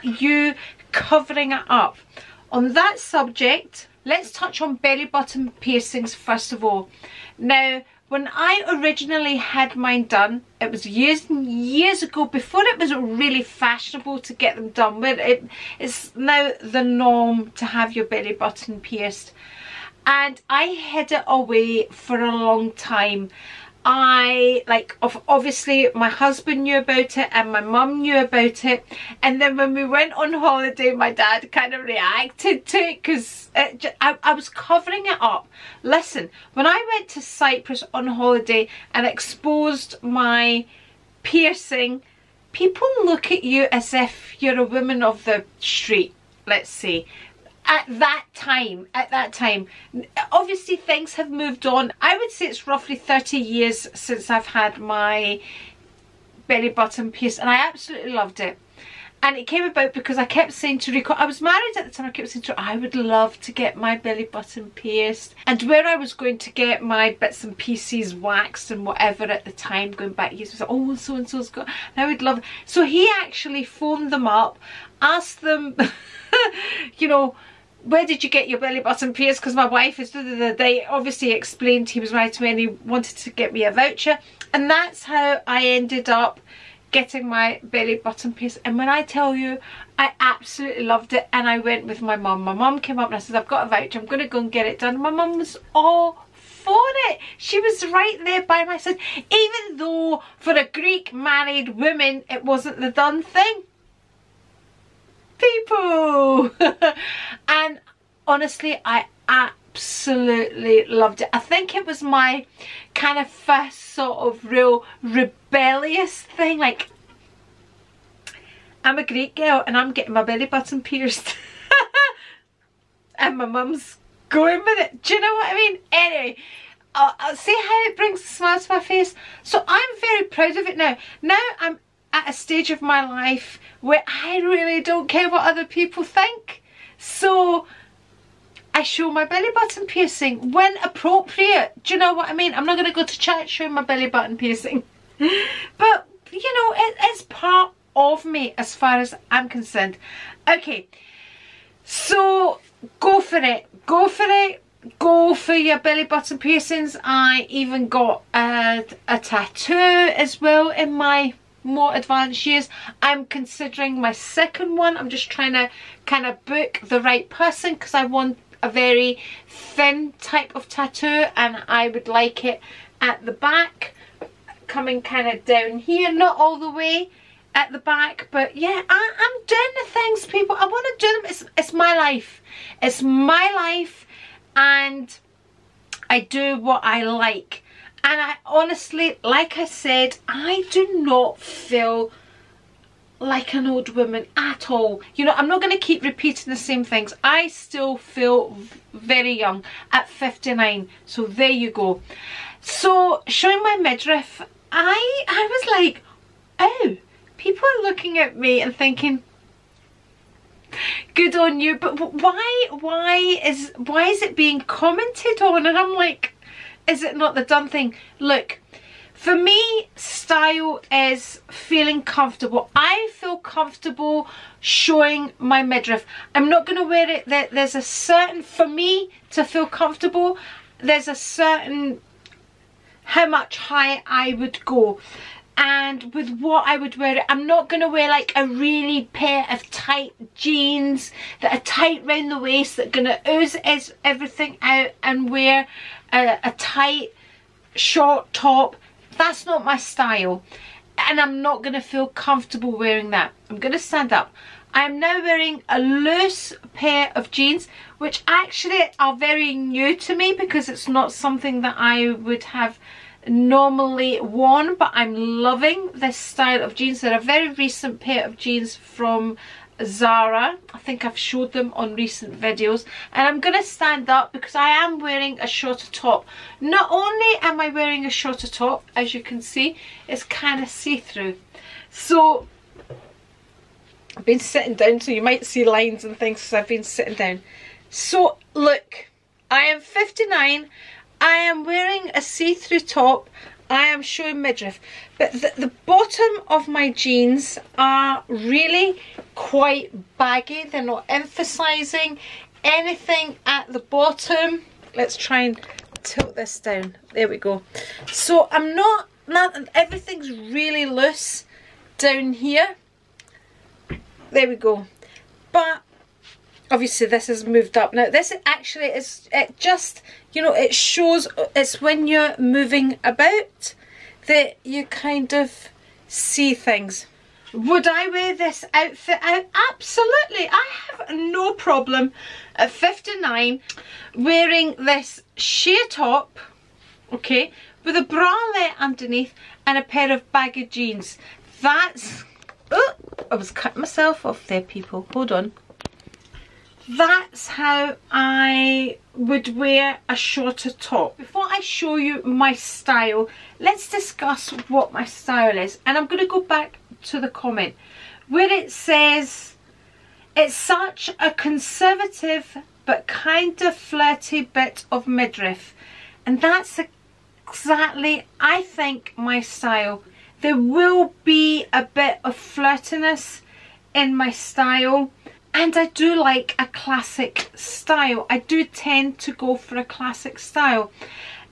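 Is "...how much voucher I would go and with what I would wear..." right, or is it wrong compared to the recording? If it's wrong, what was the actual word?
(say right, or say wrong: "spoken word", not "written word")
wrong: "higher", not "voucher".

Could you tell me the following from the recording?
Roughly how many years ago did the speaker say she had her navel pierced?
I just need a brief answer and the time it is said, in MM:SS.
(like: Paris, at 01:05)
30, at 00:52.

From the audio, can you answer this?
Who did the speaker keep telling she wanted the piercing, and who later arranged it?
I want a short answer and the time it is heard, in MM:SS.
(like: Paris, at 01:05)
Rico, at 01:00.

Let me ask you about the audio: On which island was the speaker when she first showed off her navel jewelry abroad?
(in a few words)
Cyprus.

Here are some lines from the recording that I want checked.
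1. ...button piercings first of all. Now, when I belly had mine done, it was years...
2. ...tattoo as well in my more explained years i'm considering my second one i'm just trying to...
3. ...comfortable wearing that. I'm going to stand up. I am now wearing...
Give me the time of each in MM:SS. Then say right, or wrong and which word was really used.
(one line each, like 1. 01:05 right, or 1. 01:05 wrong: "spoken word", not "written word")
1. 00:05 wrong: "originally", not "belly"
2. 02:39 wrong: "advanced", not "explained"
3. 04:12 right.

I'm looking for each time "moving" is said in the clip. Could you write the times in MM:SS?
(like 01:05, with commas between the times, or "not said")
05:22.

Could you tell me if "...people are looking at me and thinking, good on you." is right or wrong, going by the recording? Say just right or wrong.
right.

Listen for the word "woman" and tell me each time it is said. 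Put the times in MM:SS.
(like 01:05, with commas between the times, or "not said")
00:44, 01:41, 03:13.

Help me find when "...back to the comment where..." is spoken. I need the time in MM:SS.
05:56.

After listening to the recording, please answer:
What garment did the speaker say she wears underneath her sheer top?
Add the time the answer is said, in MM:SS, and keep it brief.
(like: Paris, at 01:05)
A bralette, at 05:38.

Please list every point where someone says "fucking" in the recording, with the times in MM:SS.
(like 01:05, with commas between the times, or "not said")
not said.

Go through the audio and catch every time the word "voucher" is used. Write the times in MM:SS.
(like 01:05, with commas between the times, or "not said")
01:23, 01:33.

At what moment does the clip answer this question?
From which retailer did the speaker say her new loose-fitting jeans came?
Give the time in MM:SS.
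04:29.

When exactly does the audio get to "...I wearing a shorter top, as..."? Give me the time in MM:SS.
04:37.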